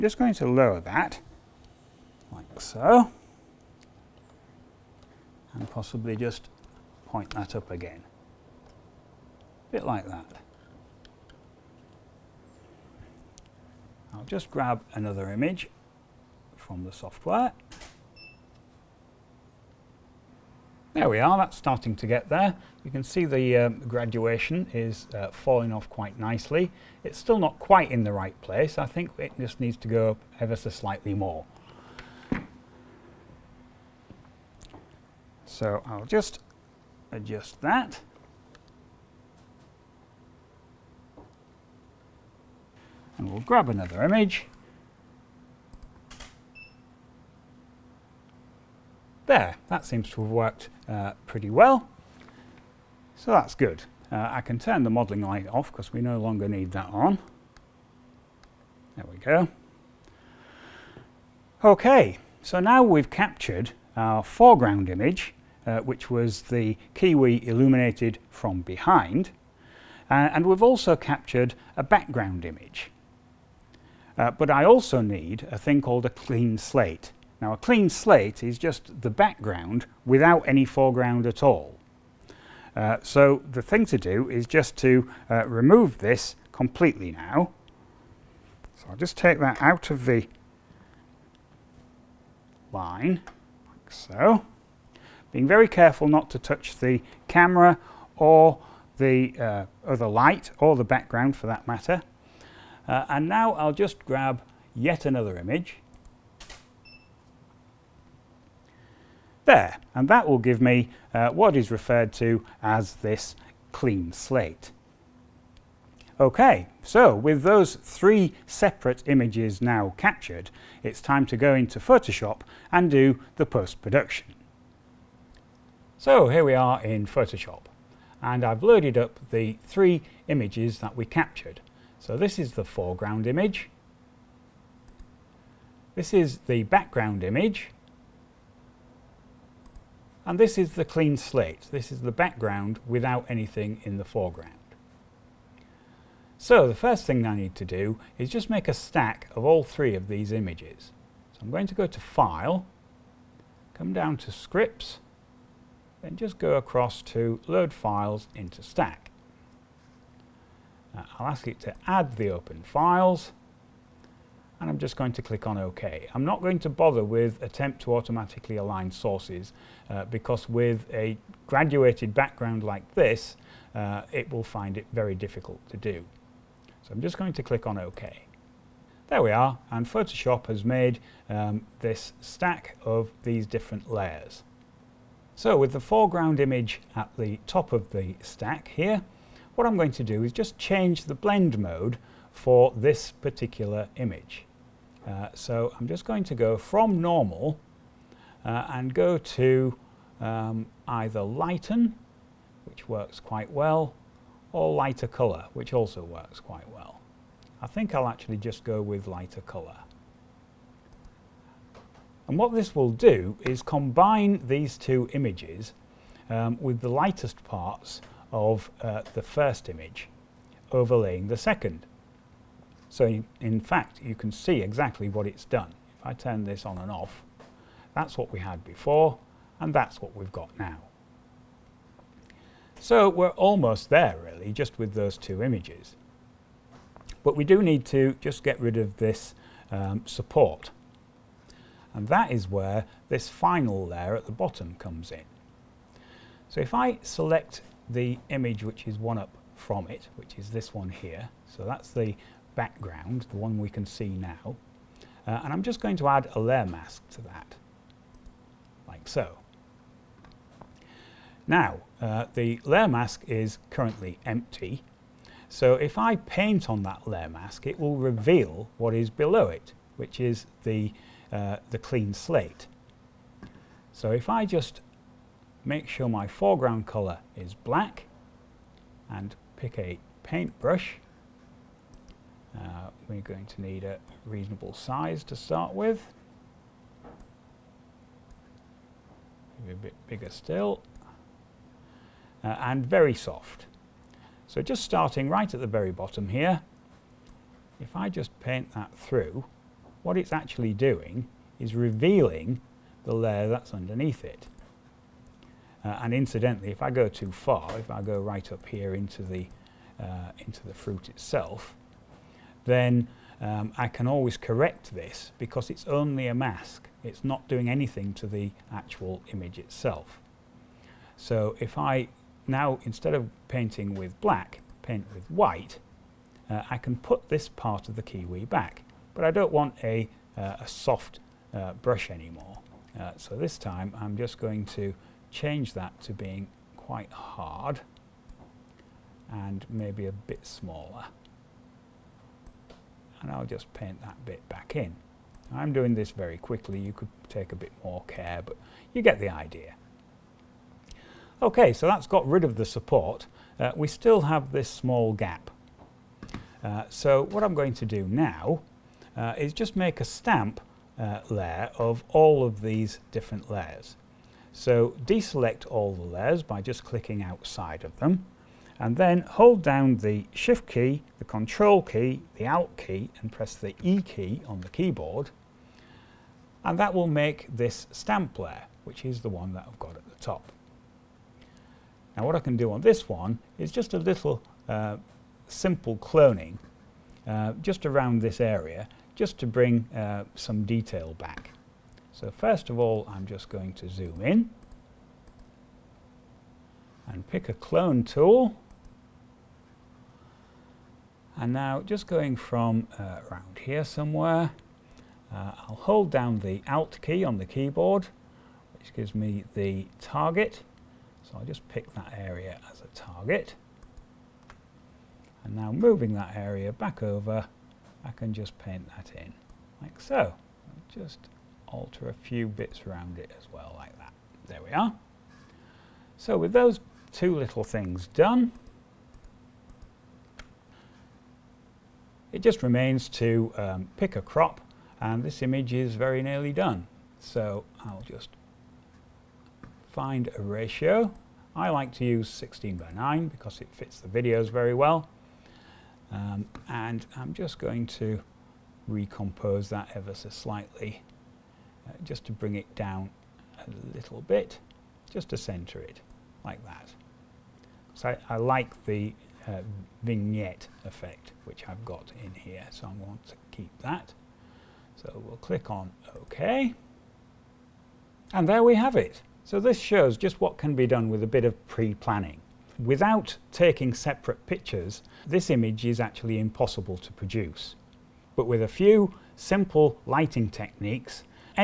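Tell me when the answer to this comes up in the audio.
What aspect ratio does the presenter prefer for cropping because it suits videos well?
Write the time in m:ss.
7:22.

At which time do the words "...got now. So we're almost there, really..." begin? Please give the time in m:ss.
3:50.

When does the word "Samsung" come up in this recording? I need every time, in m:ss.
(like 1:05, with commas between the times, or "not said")
not said.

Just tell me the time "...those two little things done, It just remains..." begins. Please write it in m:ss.
7:06.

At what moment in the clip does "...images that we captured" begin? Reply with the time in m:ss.
2:10.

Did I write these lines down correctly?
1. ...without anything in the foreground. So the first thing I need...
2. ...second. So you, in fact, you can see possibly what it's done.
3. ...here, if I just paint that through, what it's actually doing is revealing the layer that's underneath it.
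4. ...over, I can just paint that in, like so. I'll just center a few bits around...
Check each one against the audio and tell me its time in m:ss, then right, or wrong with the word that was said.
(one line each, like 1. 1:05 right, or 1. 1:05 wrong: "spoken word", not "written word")
1. 2:22 right
2. 3:41 wrong: "exactly", not "possibly"
3. 4:56 right
4. 6:57 wrong: "alter", not "center".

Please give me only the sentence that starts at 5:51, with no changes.
Okay, so that's got rid of the support.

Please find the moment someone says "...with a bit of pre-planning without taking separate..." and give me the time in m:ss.
7:51.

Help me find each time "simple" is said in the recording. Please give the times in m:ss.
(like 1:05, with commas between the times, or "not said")
6:25, 7:59.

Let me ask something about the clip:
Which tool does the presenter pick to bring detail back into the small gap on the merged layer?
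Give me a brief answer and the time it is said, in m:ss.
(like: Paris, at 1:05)
clone tool, at 6:37.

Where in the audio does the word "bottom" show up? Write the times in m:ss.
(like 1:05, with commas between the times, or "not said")
4:04, 4:55.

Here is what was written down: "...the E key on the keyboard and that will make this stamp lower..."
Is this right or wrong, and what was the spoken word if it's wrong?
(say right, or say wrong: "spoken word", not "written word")
wrong: "layer", not "lower".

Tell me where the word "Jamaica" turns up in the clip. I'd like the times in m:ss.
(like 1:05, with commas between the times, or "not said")
not said.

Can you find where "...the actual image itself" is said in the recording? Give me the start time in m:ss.
5:18.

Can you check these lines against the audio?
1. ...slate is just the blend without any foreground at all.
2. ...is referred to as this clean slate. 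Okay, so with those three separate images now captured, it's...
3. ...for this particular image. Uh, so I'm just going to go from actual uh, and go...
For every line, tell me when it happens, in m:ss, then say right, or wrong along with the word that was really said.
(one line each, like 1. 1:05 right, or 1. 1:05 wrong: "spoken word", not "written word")
1. 1:17 wrong: "background", not "blend"
2. 1:51 right
3. 3:12 wrong: "normal", not "actual".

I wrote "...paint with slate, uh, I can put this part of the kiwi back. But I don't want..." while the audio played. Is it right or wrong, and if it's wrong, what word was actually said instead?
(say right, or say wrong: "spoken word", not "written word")
wrong: "white", not "slate".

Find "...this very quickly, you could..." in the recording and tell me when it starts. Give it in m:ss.
5:45.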